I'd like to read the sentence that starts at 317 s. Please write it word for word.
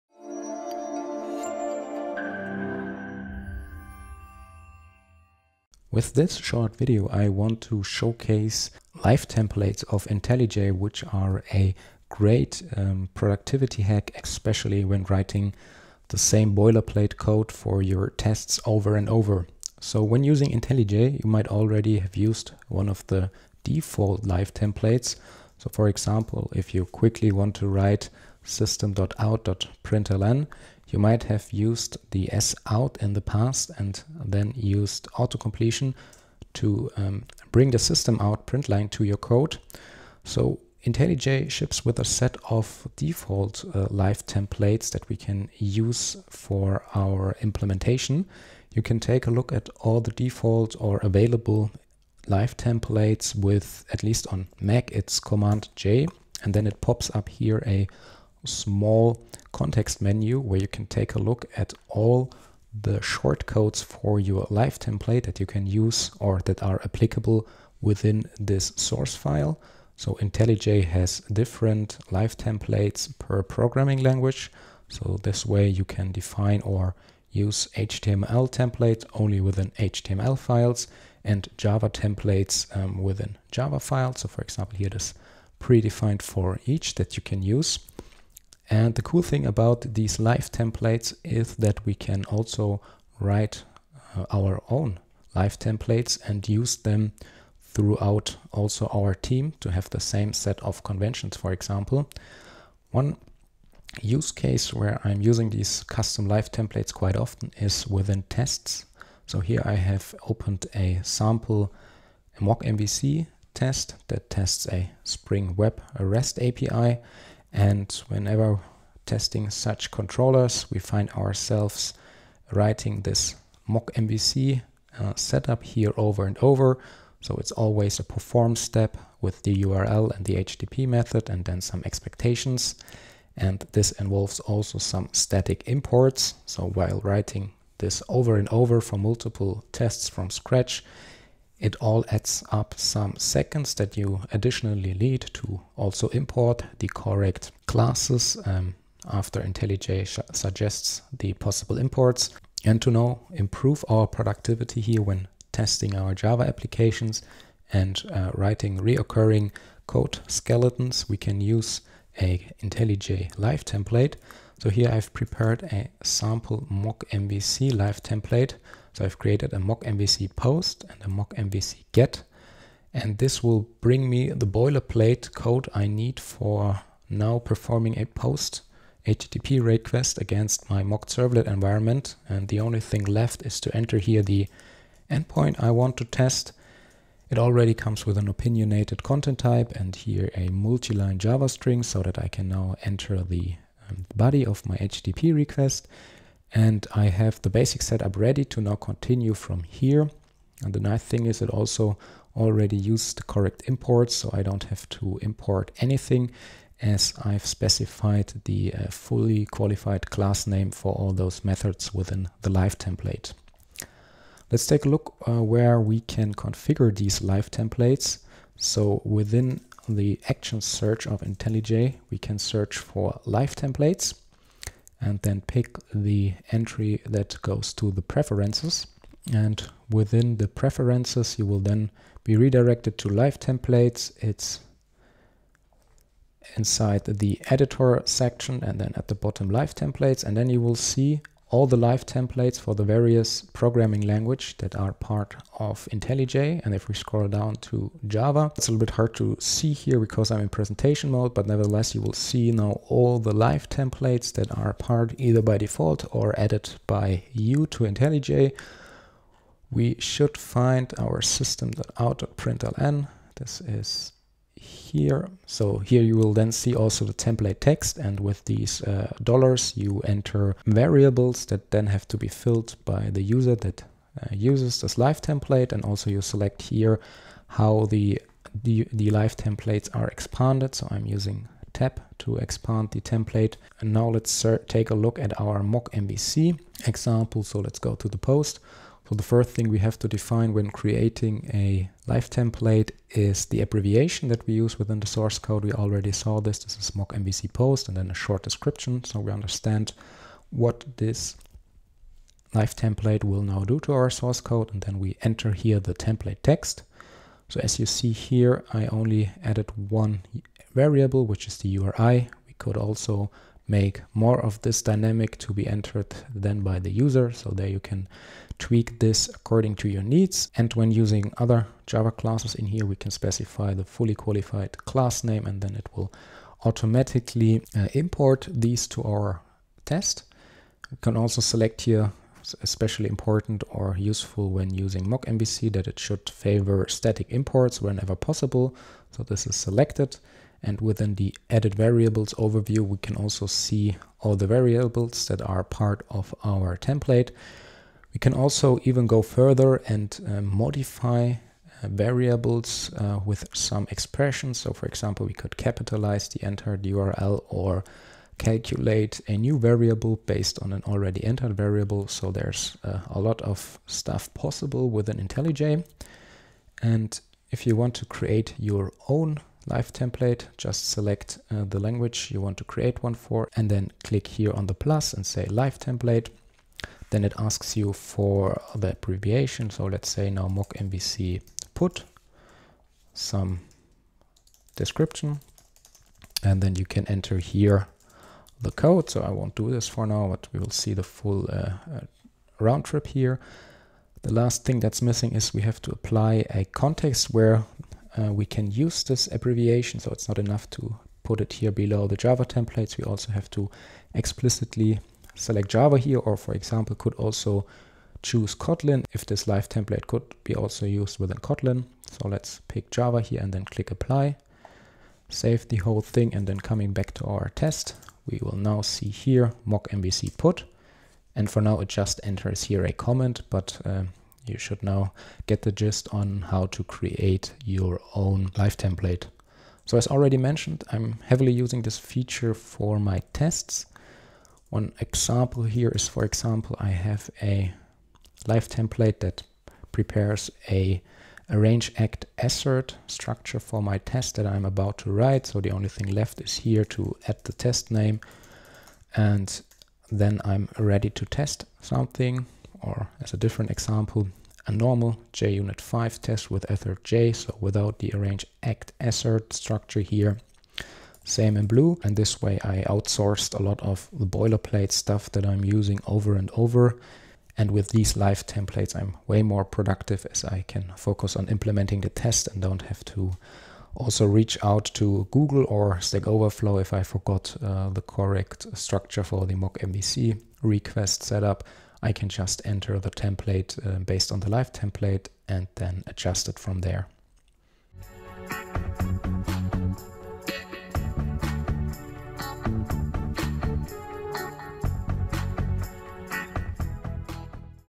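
So there you can tweak this according to your needs.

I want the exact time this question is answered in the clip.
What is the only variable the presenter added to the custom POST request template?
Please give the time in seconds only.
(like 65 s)
311 s.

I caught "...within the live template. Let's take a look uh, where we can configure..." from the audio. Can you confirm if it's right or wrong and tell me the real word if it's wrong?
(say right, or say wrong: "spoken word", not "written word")
right.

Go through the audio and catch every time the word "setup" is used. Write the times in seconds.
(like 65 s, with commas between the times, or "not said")
125 s, 197 s, 481 s.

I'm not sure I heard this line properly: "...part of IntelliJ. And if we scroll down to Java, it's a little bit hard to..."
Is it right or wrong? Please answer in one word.
right.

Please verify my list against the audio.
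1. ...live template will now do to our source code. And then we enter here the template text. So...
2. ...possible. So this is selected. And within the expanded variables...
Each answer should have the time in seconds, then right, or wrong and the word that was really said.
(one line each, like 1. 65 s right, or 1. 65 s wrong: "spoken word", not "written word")
1. 302 s right
2. 338 s wrong: "added", not "expanded".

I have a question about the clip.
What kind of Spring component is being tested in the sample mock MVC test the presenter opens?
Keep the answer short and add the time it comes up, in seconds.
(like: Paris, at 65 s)
Spring Web REST API, at 115 s.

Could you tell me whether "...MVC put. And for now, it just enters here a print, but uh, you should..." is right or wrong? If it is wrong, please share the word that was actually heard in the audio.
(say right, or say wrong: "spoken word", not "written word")
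wrong: "comment", not "print".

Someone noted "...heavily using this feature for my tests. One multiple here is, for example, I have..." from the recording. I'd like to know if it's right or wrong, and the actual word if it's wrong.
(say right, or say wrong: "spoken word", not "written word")
wrong: "example", not "multiple".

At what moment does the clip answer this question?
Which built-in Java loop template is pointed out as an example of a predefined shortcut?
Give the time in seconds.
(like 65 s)
86 s.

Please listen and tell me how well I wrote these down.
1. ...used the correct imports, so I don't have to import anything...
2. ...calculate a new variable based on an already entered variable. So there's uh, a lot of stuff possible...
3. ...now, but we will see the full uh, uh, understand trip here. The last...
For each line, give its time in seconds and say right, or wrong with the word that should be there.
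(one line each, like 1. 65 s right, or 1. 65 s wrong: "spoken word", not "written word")
1. 202 s right
2. 358 s right
3. 390 s wrong: "round", not "understand".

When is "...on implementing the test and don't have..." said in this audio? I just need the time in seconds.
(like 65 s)
471 s.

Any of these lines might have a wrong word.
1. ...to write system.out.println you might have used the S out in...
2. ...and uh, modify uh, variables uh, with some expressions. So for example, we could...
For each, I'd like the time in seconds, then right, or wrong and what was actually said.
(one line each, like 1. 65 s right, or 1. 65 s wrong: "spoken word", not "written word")
1. 27 s right
2. 349 s right.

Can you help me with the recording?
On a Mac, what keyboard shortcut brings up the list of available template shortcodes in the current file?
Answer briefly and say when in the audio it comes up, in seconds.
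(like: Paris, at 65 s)
Command J, at 55 s.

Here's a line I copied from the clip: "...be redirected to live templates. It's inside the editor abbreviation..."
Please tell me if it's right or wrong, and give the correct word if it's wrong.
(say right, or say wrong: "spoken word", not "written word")
wrong: "section", not "abbreviation".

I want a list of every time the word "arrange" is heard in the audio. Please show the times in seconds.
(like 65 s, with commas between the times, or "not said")
441 s, 458 s.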